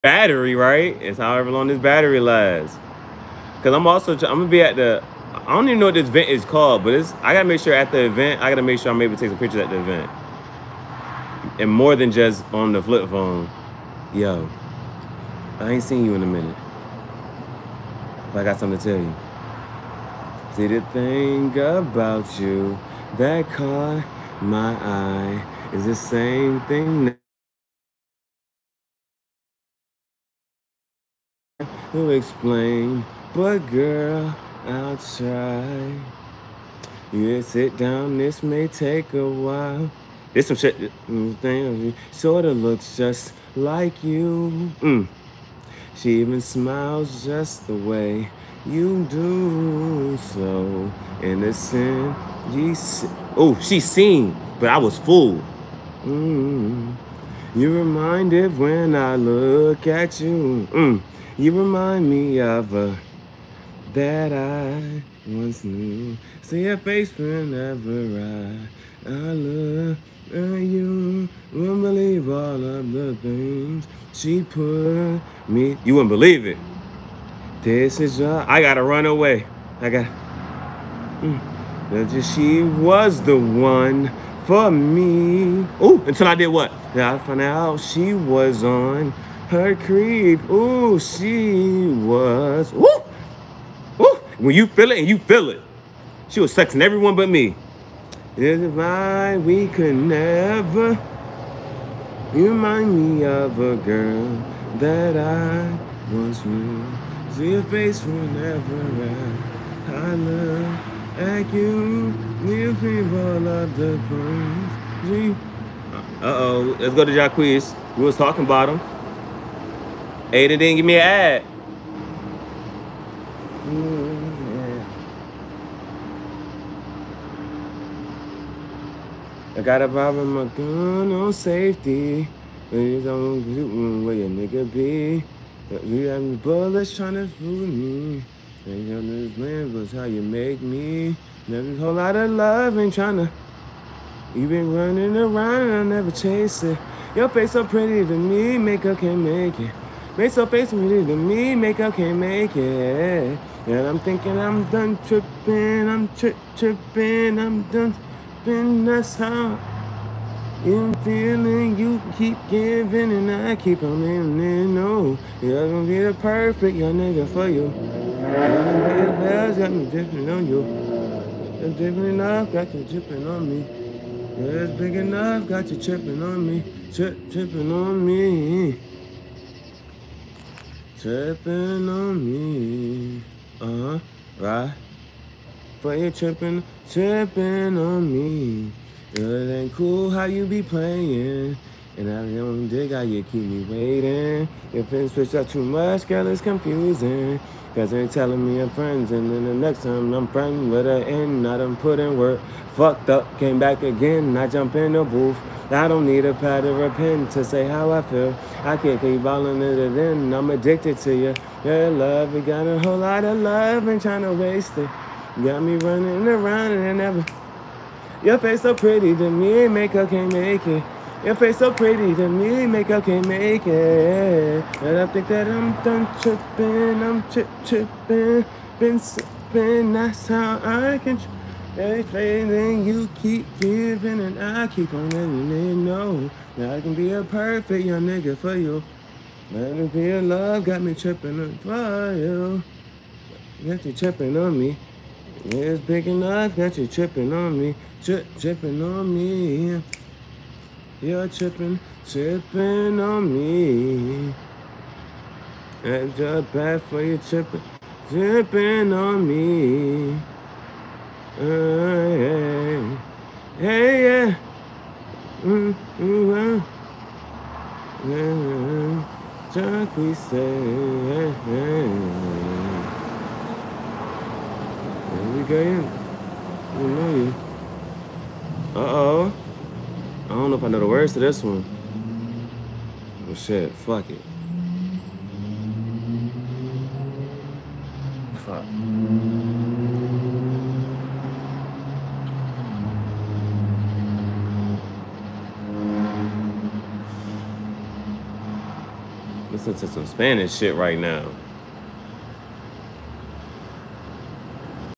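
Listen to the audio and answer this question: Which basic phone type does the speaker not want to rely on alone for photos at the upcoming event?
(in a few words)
flip phone.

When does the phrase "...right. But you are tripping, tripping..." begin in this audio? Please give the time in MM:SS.
03:04.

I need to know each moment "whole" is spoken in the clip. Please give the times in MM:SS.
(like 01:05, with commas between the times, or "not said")
02:21, 03:32.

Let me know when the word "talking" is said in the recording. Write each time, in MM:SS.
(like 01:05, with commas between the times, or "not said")
01:58.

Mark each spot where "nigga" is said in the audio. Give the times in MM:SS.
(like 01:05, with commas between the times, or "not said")
02:14, 02:46, 03:58.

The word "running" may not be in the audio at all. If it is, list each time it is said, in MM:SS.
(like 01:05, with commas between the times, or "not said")
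02:24, 03:35.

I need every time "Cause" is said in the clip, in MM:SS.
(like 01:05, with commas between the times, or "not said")
00:03, 03:17.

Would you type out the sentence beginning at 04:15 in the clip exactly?
And your bad for you tripping, tripping on me.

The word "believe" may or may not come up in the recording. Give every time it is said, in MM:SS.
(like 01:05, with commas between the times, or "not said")
01:11, 01:16.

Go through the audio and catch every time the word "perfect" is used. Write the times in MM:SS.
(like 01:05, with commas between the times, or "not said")
02:46, 03:57.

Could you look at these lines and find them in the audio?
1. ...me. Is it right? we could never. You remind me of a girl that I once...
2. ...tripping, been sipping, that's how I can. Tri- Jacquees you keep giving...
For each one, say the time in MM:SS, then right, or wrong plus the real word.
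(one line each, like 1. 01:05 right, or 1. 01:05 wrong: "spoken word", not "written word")
1. 01:37 right
2. 03:47 wrong: "Everything", not "Jacquees".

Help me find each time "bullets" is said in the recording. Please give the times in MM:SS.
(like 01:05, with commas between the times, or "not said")
02:16.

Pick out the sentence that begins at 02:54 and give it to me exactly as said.
Yeah, it's big enough, got you tripping on me.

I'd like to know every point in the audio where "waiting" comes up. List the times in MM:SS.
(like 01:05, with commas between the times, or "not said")
03:13.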